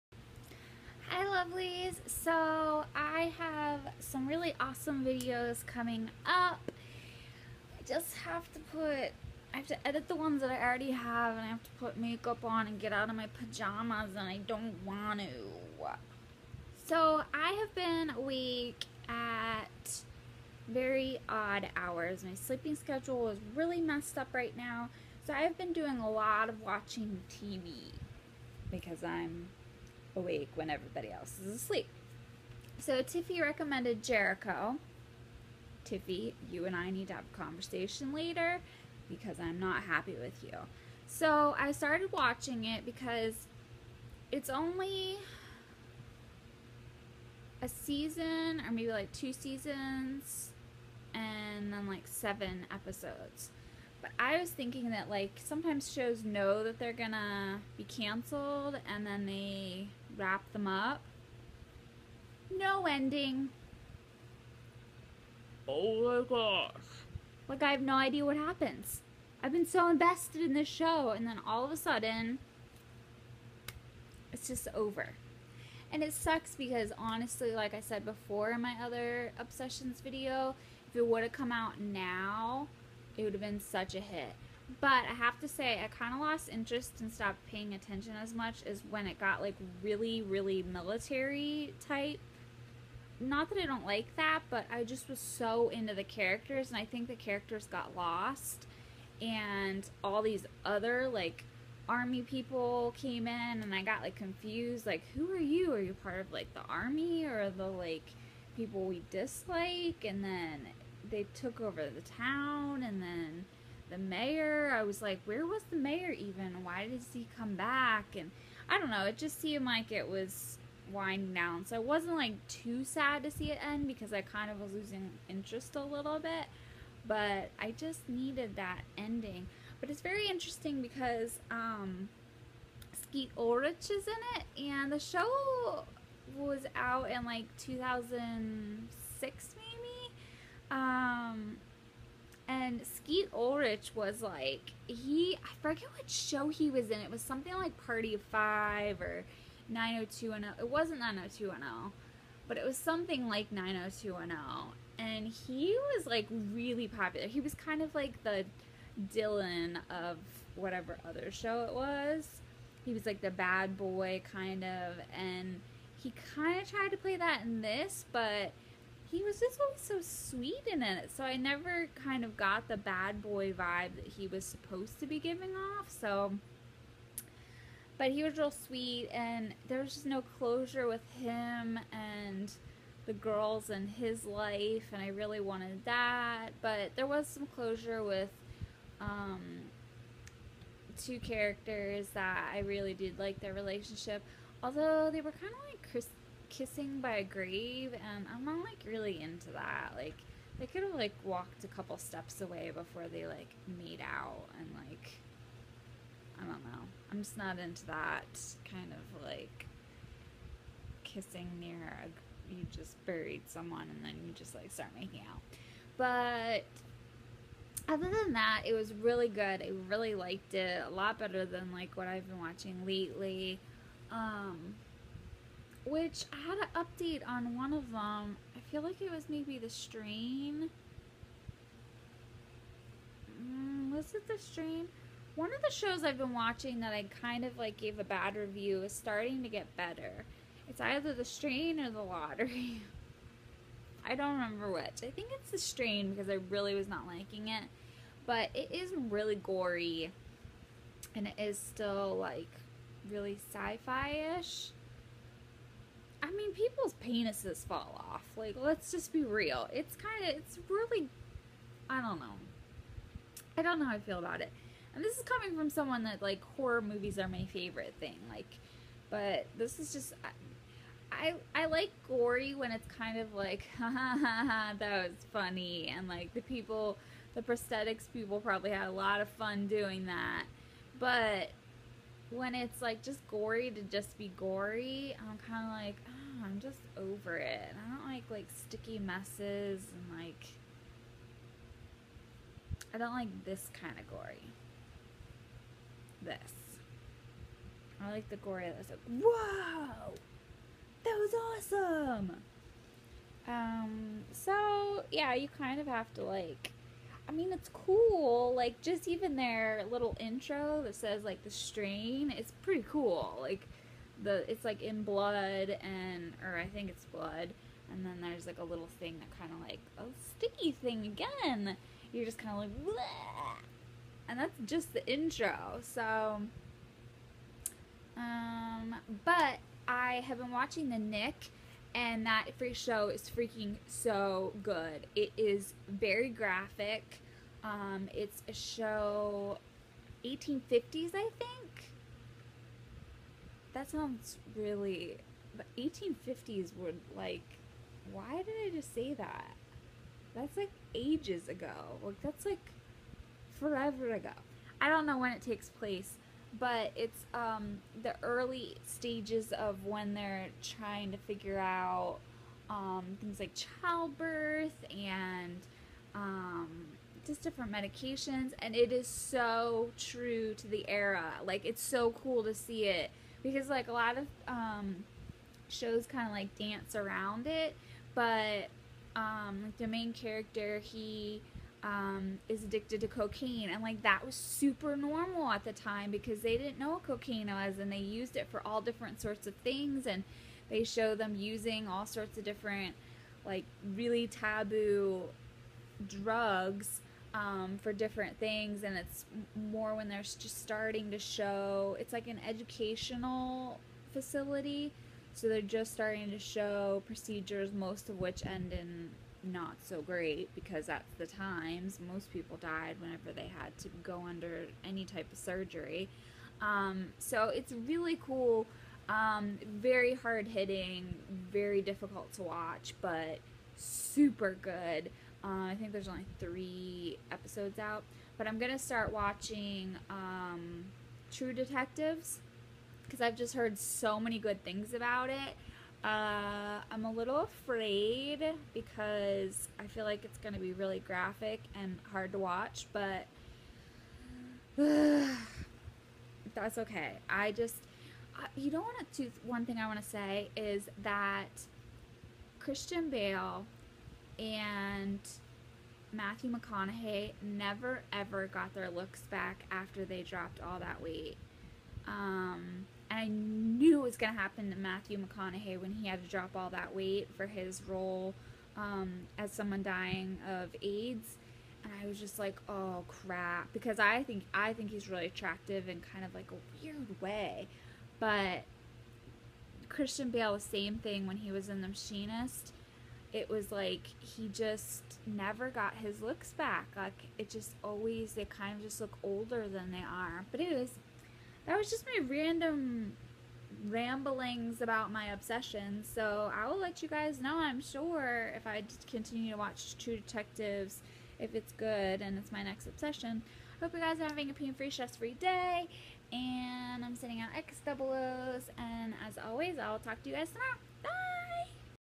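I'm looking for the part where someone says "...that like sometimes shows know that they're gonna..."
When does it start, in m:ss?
0:54.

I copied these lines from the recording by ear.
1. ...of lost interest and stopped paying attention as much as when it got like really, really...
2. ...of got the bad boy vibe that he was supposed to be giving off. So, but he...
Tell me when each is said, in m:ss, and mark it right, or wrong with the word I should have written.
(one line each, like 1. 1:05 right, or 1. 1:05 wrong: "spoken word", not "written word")
1. 1:26 right
2. 2:52 right.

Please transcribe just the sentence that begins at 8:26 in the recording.
And I'm sending out X double O's.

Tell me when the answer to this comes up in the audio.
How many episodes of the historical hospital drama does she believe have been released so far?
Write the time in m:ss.
7:06.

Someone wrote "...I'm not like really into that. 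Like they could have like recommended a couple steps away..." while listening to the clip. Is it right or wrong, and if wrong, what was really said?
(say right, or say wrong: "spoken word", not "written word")
wrong: "walked", not "recommended".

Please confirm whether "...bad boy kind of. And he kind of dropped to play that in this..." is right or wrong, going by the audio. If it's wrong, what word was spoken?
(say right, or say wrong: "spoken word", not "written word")
wrong: "tried", not "dropped".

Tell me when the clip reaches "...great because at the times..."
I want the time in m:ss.
6:50.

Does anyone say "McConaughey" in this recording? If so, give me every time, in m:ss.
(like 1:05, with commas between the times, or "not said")
7:36, 7:45.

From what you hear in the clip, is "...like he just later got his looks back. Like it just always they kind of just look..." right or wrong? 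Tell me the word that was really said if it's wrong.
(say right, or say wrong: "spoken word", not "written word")
wrong: "never", not "later".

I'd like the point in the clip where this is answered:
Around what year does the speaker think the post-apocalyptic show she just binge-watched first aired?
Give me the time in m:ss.
2:17.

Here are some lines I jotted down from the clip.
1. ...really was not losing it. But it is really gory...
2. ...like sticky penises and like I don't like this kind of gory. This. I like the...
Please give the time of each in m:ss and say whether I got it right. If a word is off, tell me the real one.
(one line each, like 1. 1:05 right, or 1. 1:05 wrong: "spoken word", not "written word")
1. 4:06 wrong: "liking", not "losing"
2. 4:48 wrong: "messes", not "penises".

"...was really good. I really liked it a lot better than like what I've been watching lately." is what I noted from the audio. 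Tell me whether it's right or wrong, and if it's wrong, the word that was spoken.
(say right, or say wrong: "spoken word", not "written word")
right.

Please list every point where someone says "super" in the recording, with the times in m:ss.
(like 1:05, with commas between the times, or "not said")
6:24, 7:03.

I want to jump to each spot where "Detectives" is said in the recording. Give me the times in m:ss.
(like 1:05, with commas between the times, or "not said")
7:11, 8:20.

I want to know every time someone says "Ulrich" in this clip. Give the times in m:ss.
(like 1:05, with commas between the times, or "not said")
2:13, 2:23.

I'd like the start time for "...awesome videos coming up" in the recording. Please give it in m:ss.
0:04.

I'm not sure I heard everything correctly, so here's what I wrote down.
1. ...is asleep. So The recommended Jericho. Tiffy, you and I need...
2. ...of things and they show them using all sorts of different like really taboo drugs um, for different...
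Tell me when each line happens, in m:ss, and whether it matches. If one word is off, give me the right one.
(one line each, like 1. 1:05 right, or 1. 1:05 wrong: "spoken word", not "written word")
1. 0:31 wrong: "Tiffy", not "The"
2. 6:29 right.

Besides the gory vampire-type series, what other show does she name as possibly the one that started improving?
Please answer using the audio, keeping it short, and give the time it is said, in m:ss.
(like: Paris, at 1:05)
The Lottery, at 4:01.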